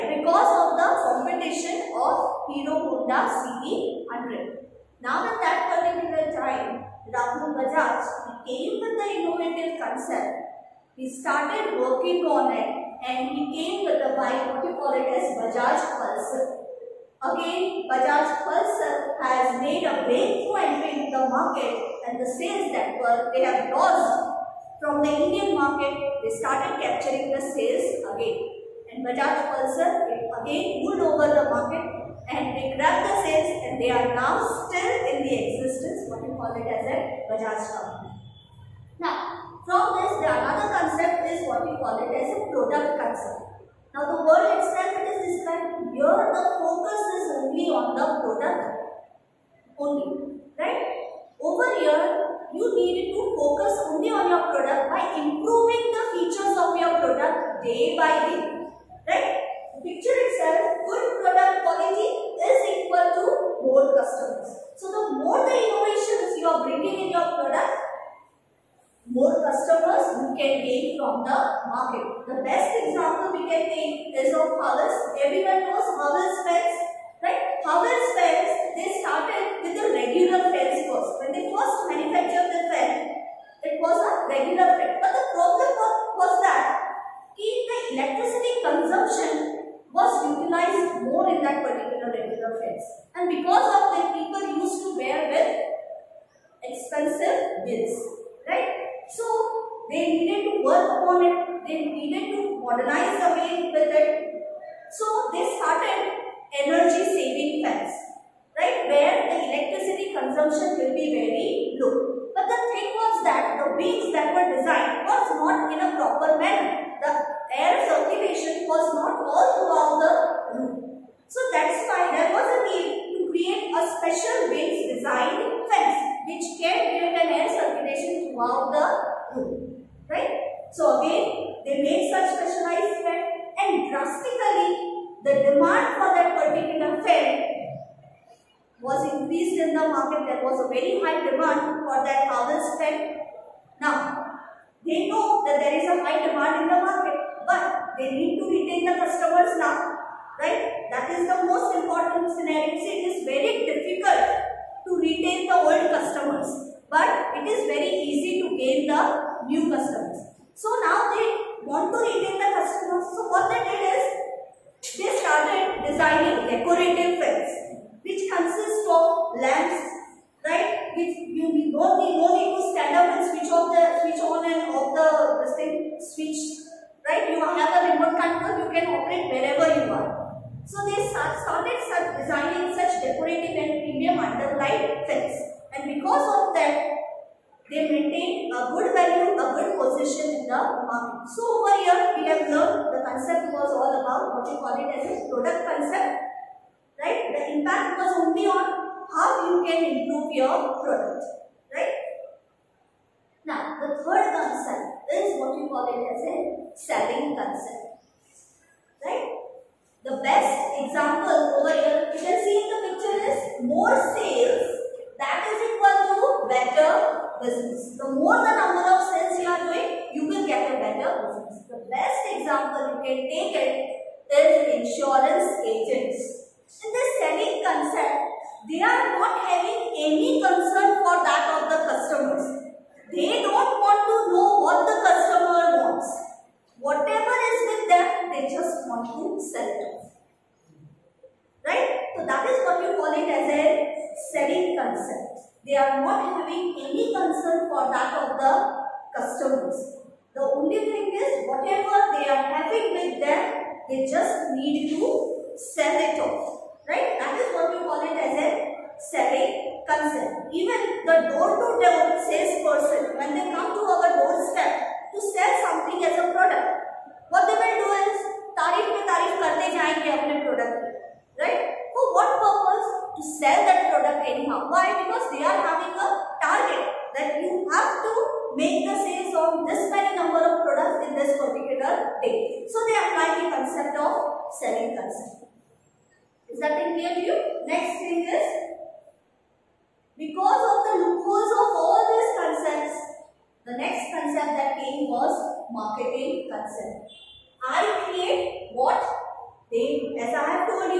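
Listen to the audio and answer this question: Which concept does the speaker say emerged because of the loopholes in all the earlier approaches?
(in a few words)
Marketing concept.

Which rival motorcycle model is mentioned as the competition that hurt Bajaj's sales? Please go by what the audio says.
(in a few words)
Hero Honda CD100.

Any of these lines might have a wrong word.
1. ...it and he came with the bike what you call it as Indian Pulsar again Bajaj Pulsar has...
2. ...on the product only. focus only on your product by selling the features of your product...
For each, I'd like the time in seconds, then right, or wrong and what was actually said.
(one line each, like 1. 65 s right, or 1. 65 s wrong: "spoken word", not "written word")
1. 12 s wrong: "Bajaj", not "Indian"
2. 47 s wrong: "improving", not "selling".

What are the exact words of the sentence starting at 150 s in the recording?
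That is the most important scenario.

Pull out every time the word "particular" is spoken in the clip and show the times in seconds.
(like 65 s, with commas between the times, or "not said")
5 s, 136 s, 281 s.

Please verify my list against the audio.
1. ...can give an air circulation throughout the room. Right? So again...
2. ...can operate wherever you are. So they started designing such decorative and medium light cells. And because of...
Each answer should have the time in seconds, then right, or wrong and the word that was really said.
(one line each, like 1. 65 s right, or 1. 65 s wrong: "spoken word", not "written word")
1. 126 s right
2. 178 s right.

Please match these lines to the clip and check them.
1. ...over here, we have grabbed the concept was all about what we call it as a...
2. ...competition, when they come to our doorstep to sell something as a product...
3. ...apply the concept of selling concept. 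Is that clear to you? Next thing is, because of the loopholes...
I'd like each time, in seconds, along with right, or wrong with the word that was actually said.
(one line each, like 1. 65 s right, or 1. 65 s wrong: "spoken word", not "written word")
1. 191 s wrong: "learned", not "grabbed"
2. 262 s wrong: "salesperson", not "competition"
3. 282 s right.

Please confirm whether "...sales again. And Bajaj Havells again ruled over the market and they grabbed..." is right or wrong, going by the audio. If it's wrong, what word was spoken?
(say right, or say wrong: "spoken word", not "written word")
wrong: "Pulsar", not "Havells".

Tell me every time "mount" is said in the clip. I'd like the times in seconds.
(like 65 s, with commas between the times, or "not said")
not said.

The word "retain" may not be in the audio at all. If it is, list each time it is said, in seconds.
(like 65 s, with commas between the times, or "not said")
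148 s, 154 s, 162 s.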